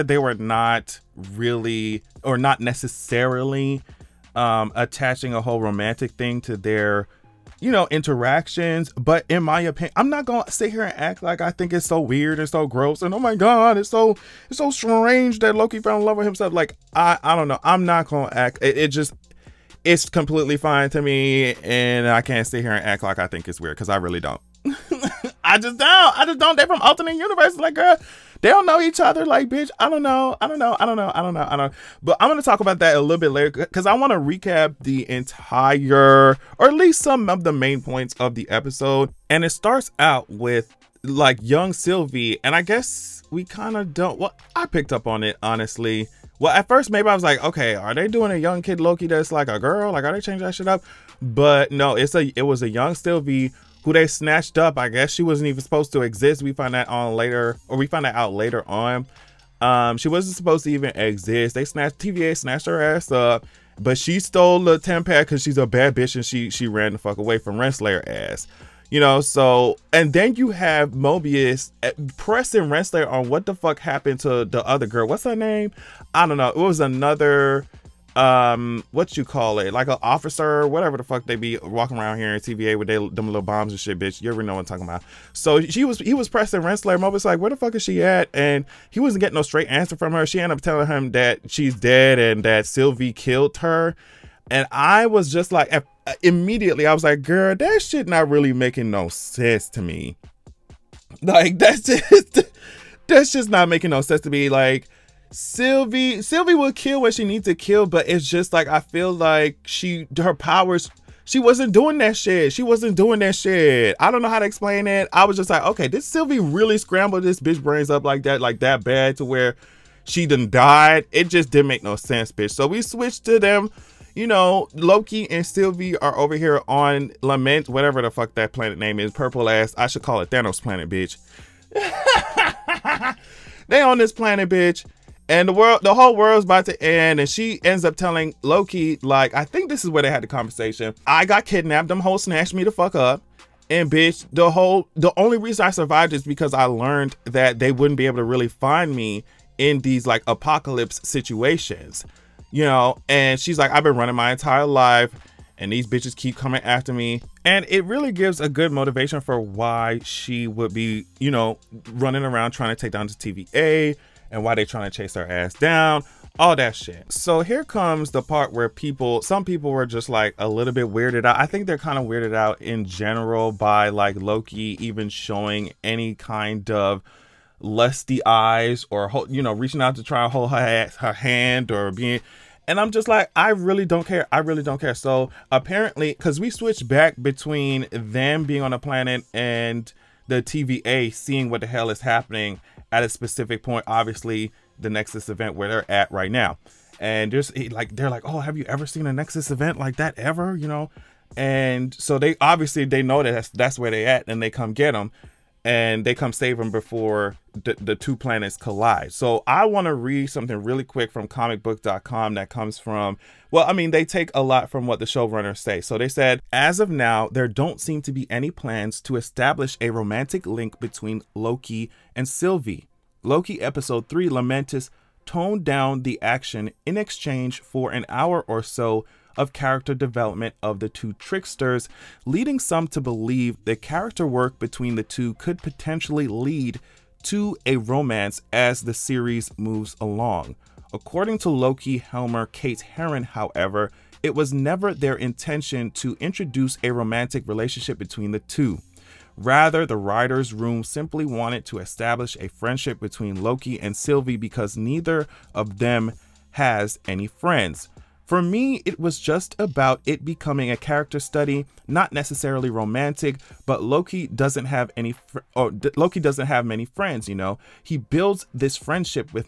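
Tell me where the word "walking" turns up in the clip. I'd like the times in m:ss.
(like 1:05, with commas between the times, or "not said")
1:21.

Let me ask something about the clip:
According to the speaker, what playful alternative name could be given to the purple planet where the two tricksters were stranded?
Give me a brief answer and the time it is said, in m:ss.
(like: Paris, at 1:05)
Thanos planet, at 2:10.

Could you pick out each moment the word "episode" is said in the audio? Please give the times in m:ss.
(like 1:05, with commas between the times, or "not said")
0:38, 3:43.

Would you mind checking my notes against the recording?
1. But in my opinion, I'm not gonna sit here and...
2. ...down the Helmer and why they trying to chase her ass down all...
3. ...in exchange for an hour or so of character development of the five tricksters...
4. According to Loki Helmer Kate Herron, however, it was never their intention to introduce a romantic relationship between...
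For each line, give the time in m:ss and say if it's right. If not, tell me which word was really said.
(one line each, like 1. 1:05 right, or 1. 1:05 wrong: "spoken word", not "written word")
1. 0:08 right
2. 2:42 wrong: "TVA", not "Helmer"
3. 3:46 wrong: "two", not "five"
4. 4:00 right.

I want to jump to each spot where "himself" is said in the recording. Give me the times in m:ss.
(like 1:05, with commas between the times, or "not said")
0:16.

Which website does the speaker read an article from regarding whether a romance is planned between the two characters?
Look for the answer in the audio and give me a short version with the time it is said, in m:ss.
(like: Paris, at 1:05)
comicbook.com, at 3:31.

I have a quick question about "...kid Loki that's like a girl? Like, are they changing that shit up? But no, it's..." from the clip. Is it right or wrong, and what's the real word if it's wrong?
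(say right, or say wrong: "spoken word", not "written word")
right.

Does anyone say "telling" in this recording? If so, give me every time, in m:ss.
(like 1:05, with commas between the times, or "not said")
1:30, 2:17.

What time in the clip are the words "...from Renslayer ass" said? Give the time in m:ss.
1:07.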